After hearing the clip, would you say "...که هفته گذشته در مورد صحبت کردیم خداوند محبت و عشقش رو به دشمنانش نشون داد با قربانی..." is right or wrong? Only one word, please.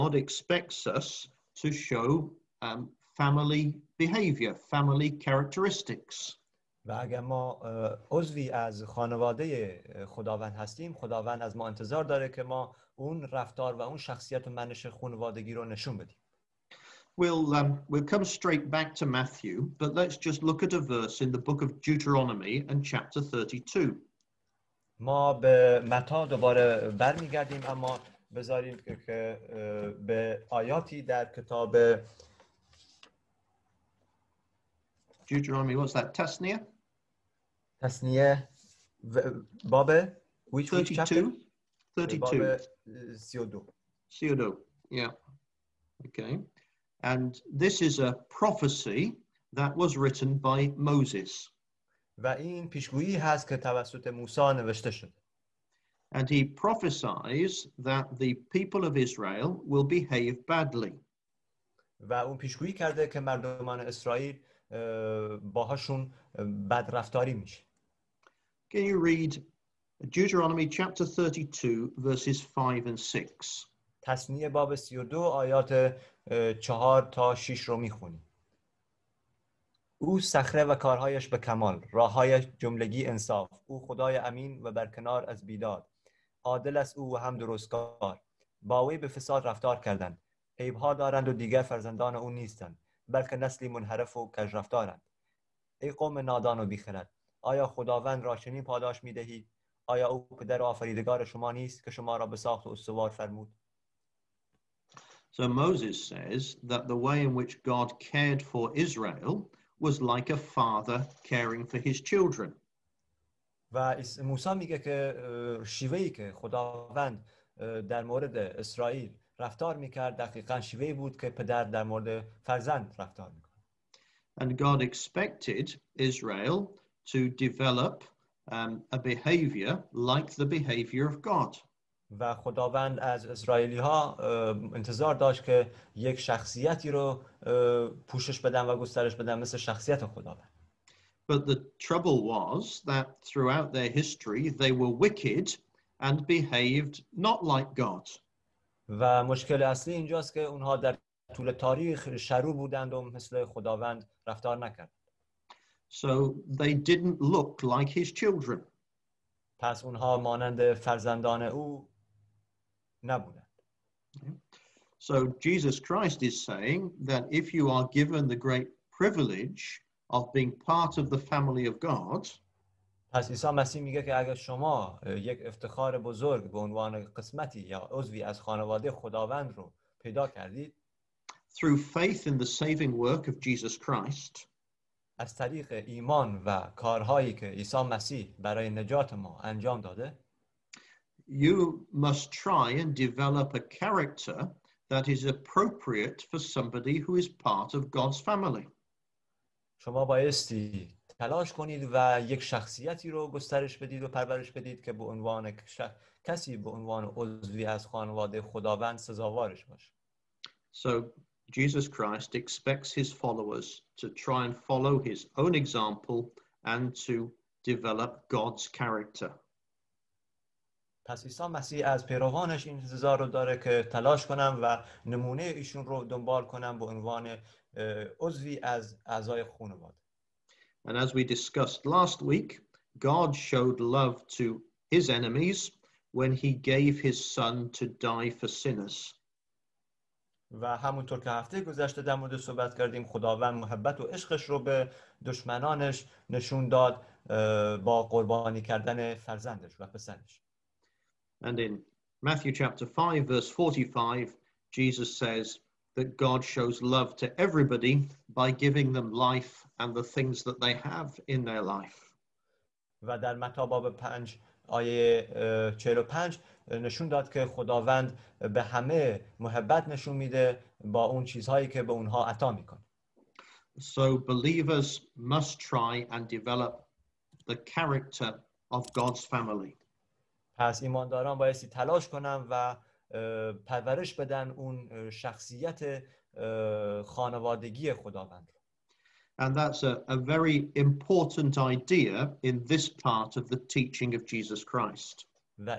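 right.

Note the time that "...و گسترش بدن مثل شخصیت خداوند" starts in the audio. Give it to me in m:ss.
2:18.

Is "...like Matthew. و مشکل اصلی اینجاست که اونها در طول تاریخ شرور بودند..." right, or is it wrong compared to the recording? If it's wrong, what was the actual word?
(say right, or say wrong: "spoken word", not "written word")
wrong: "God", not "Matthew".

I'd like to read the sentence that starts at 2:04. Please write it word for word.
And God expected Israel to develop um, a behavior like the behavior of God.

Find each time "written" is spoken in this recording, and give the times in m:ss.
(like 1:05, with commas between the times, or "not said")
0:49.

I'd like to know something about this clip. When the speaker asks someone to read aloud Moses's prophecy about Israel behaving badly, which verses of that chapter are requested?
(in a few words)
5 and 6.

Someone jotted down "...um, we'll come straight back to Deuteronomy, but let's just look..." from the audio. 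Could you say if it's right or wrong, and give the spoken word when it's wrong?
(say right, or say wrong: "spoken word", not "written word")
wrong: "Matthew", not "Deuteronomy".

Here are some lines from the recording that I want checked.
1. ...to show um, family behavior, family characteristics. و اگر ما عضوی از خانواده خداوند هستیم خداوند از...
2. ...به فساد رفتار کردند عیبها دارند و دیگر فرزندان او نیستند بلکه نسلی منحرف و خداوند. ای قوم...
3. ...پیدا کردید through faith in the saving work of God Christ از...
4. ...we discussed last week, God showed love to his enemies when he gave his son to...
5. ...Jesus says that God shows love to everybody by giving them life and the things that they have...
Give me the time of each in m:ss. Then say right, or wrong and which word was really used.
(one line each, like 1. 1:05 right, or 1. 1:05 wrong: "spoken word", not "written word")
1. 0:01 right
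2. 1:28 wrong: "رفتارند", not "خداوند"
3. 2:59 wrong: "Jesus", not "God"
4. 3:51 right
5. 4:14 right.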